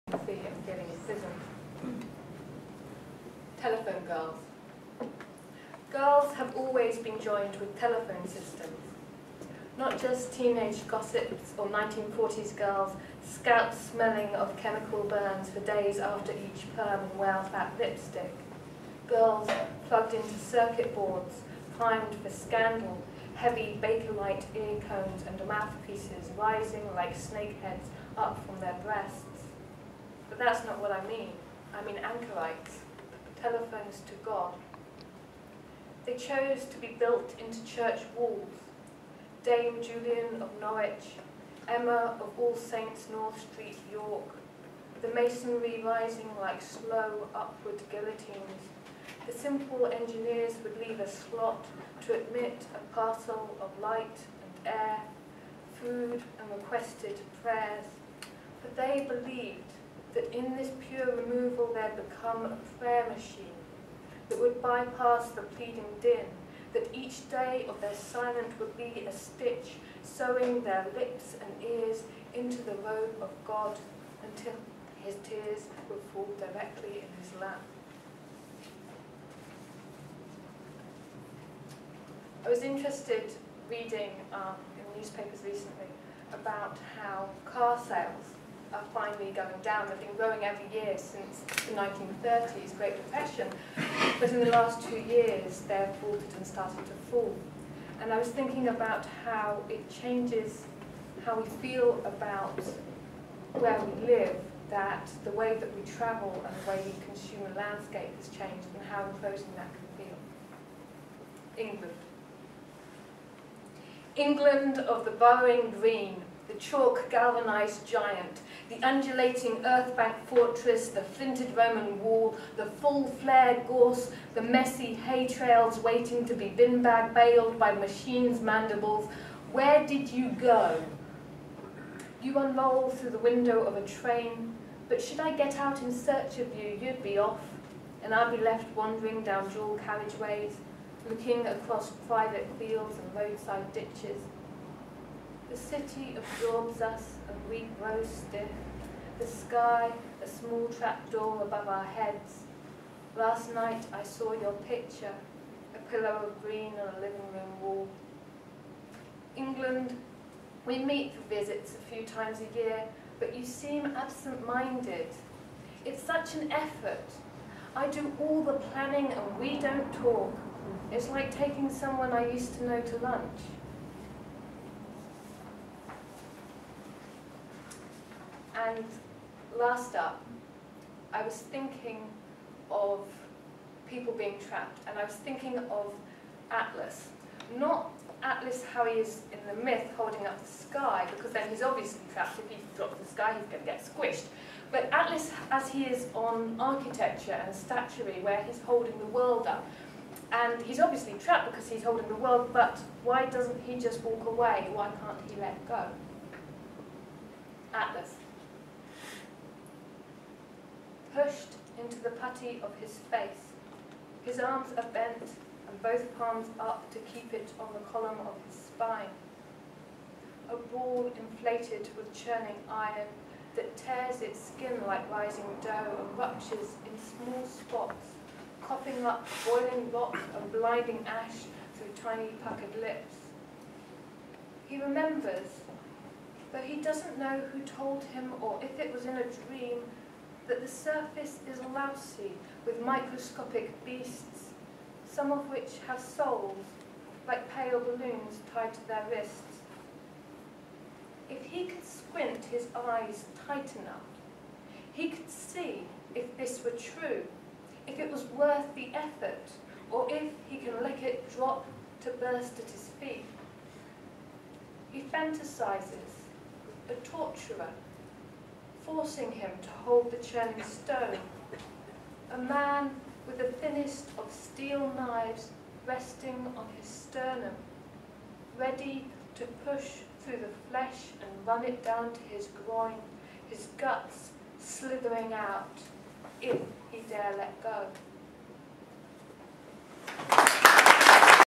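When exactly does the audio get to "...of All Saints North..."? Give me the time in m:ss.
0:42.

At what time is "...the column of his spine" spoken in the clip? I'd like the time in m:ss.
3:37.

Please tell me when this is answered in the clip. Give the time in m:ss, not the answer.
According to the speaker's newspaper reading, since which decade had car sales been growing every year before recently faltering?
1:31.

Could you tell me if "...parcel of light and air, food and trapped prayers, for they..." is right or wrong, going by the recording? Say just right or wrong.
wrong.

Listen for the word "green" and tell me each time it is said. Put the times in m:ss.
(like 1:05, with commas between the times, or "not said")
1:55, 2:36.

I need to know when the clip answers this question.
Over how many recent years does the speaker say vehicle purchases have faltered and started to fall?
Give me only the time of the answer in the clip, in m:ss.
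1:34.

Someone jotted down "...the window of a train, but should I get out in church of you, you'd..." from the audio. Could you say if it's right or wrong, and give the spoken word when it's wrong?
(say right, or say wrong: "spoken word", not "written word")
wrong: "search", not "church".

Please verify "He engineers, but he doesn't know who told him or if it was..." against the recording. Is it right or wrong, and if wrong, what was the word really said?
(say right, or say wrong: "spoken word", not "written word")
wrong: "remembers", not "engineers".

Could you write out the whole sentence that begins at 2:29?
The sky, a small trapdoor above our heads.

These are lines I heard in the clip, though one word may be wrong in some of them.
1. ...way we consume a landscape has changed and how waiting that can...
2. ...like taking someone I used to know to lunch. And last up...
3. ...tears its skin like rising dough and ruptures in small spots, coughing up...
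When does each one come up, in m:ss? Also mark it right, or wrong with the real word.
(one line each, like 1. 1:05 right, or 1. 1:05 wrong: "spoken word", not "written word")
1. 1:46 wrong: "imposing", not "waiting"
2. 2:51 right
3. 3:43 right.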